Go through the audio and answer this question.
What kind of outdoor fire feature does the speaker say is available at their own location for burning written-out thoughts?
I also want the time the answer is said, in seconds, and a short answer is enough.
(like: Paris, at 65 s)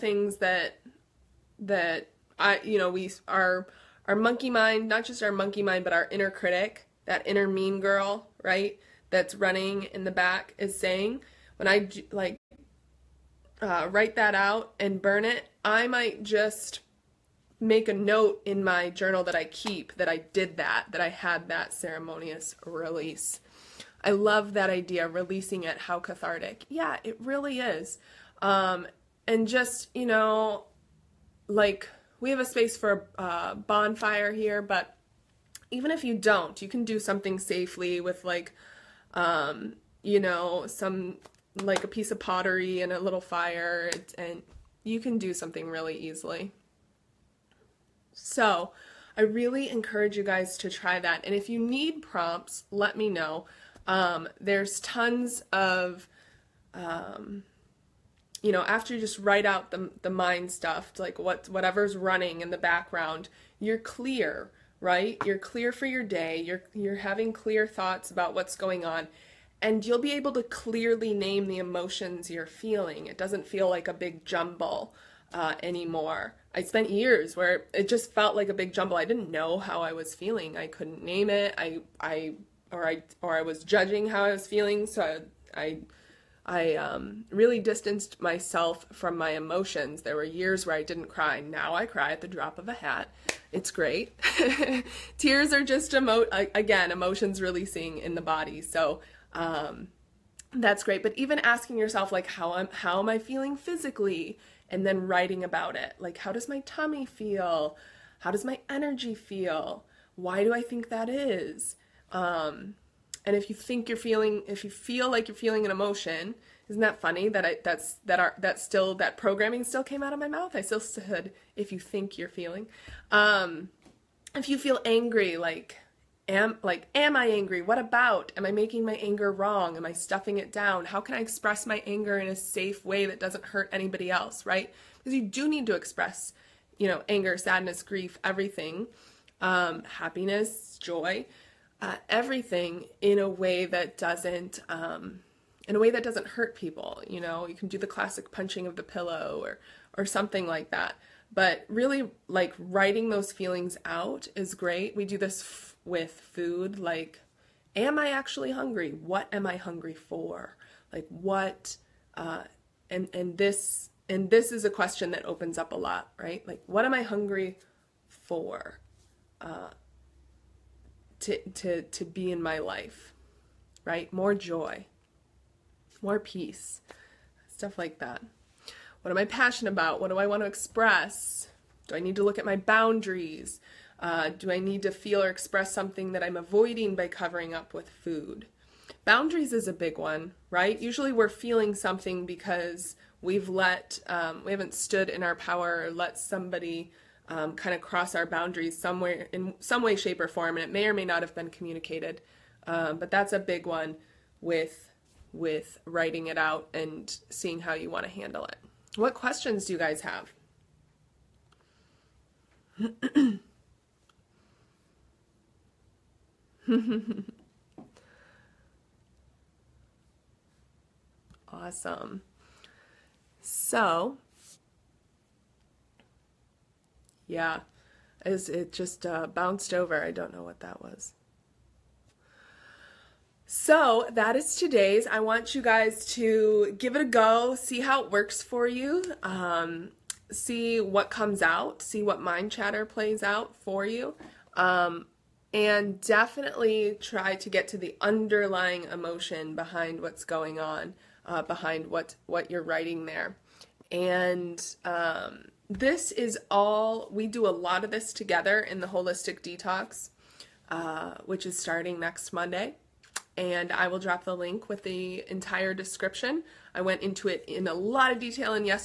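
bonfire, at 33 s.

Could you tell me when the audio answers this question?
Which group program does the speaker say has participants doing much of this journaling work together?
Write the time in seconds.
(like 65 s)
258 s.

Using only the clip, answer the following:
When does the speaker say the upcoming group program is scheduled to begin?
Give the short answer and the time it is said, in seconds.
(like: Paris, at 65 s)
next Monday, at 262 s.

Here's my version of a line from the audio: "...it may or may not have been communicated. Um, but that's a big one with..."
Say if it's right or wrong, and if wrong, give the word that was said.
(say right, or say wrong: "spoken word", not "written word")
right.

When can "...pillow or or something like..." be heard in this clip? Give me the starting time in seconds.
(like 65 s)
148 s.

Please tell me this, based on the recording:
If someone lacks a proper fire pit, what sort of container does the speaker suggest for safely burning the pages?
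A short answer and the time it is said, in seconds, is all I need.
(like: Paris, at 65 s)
pottery, at 42 s.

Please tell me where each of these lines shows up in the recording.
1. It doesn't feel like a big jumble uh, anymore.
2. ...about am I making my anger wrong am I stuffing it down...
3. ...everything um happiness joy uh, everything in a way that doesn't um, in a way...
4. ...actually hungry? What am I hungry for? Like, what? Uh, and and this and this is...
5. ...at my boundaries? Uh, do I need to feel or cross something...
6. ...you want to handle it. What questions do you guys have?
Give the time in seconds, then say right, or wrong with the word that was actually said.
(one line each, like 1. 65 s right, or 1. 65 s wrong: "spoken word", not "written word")
1. 73 s right
2. 127 s right
3. 138 s right
4. 158 s right
5. 182 s wrong: "express", not "cross"
6. 207 s right.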